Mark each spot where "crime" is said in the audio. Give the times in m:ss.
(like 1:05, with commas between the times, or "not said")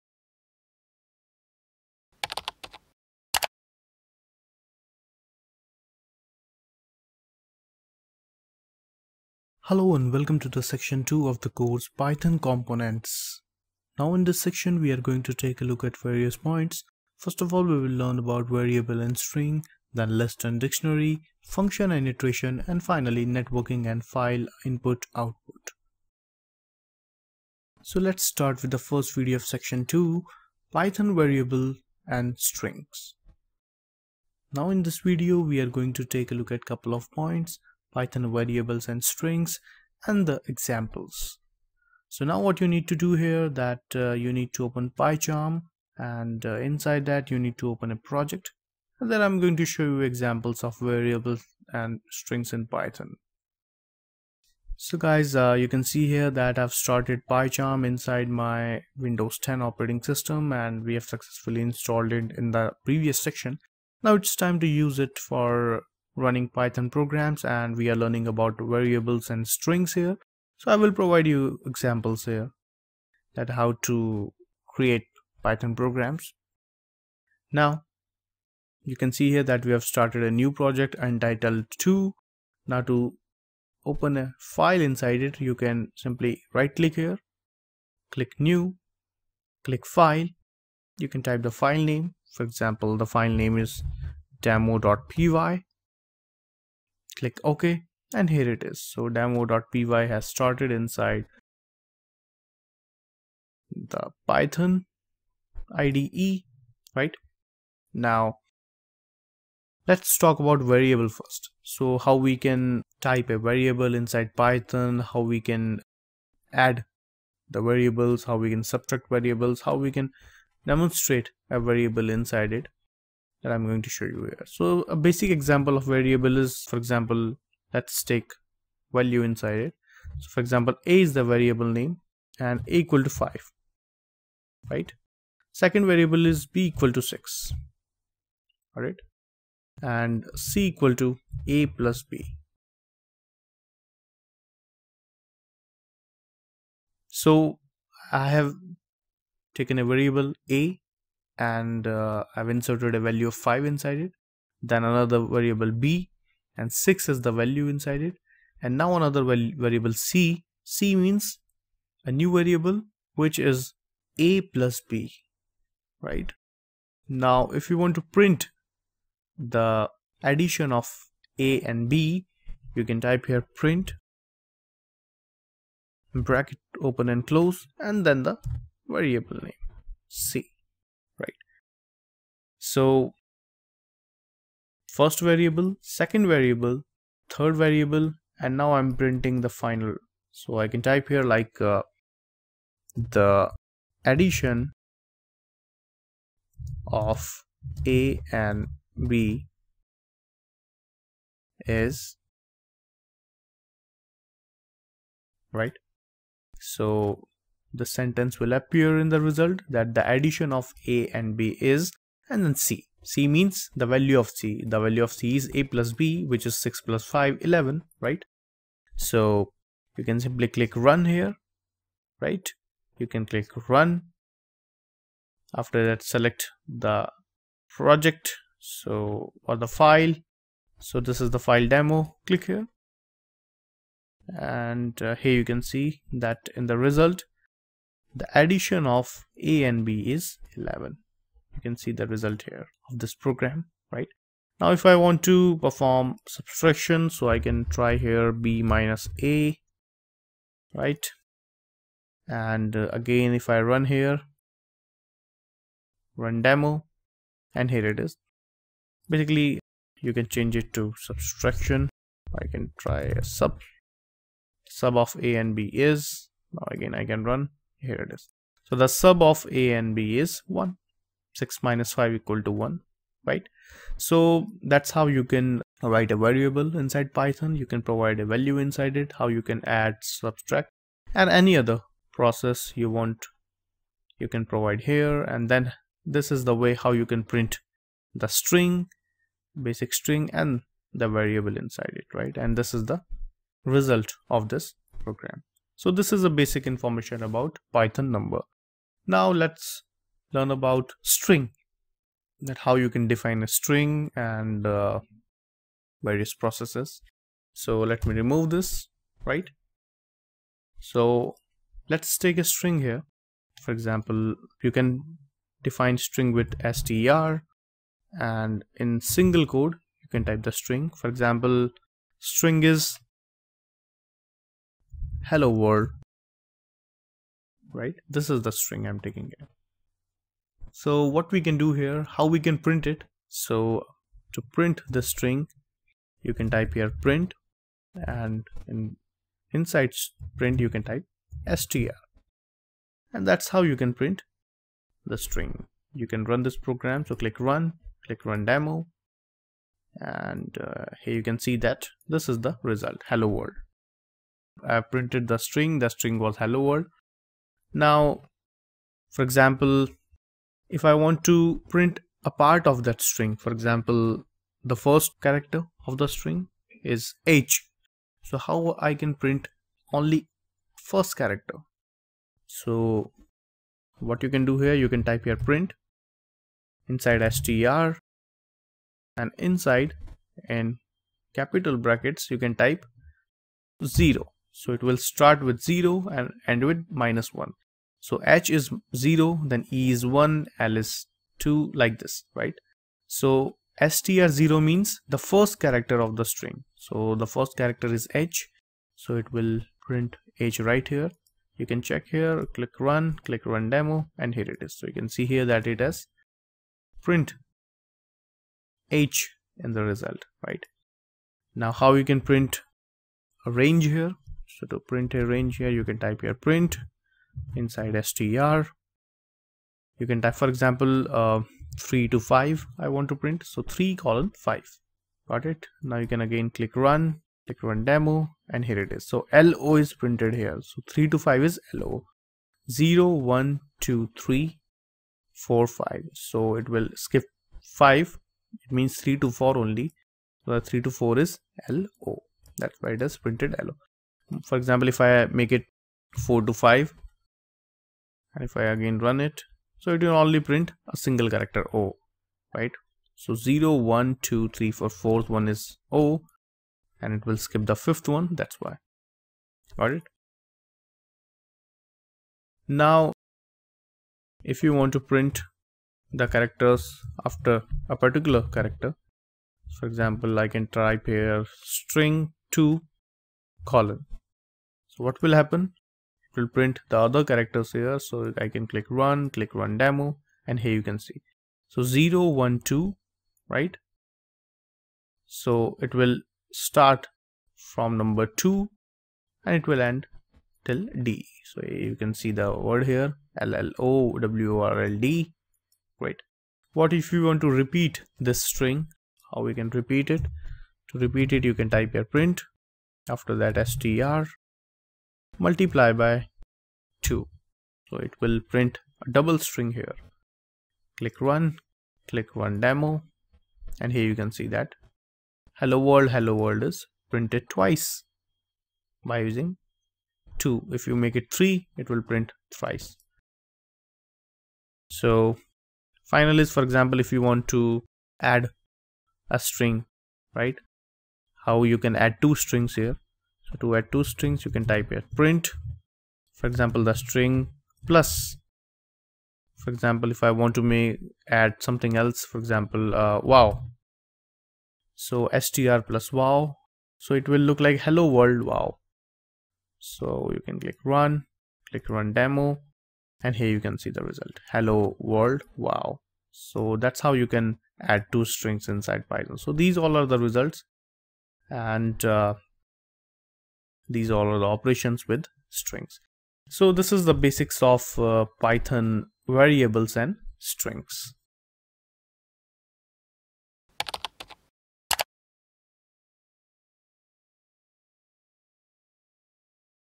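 not said.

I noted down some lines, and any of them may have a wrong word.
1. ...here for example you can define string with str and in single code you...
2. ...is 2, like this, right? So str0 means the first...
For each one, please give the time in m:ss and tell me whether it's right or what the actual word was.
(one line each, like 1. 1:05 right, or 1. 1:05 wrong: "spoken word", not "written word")
1. 5:12 right
2. 6:30 right.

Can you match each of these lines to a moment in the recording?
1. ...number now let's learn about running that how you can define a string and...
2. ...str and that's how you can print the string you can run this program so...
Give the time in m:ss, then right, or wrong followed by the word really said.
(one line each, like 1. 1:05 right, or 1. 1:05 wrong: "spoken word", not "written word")
1. 4:58 wrong: "string", not "running"
2. 5:41 right.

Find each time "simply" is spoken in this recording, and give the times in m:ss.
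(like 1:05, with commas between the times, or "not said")
1:25, 3:40.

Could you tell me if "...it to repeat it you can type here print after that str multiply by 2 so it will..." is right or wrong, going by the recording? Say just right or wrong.
right.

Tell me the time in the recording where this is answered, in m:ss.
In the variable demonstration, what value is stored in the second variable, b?
2:16.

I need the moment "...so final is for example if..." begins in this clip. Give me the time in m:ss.
8:44.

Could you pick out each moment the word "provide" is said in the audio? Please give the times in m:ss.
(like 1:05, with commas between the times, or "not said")
1:10, 4:37, 4:44.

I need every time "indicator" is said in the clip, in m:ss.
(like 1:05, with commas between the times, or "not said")
not said.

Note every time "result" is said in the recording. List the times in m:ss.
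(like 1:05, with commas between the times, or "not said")
3:29, 3:56, 4:02, 4:53, 5:52, 6:49, 9:14, 9:20.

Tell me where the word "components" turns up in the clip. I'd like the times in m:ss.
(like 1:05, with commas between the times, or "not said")
0:12.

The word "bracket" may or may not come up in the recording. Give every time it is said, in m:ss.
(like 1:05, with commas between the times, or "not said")
2:56, 6:21.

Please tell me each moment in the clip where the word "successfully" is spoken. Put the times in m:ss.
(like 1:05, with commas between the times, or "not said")
1:01.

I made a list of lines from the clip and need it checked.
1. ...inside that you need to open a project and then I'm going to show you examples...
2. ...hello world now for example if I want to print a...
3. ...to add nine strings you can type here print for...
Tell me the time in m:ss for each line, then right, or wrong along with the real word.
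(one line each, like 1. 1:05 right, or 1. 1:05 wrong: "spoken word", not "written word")
1. 0:46 right
2. 5:56 right
3. 8:53 wrong: "two", not "nine".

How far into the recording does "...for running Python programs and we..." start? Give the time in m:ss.
1:05.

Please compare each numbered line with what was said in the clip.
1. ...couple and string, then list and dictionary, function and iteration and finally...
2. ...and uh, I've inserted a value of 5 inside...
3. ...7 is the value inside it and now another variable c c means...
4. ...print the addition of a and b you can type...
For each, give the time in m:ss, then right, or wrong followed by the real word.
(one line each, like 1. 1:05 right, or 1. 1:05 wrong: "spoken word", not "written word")
1. 0:18 wrong: "variable", not "couple"
2. 2:31 right
3. 2:36 wrong: "6", not "7"
4. 2:48 right.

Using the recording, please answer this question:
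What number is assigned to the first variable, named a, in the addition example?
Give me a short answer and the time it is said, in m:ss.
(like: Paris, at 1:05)
5, at 2:12.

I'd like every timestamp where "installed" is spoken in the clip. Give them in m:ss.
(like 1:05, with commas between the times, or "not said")
1:01.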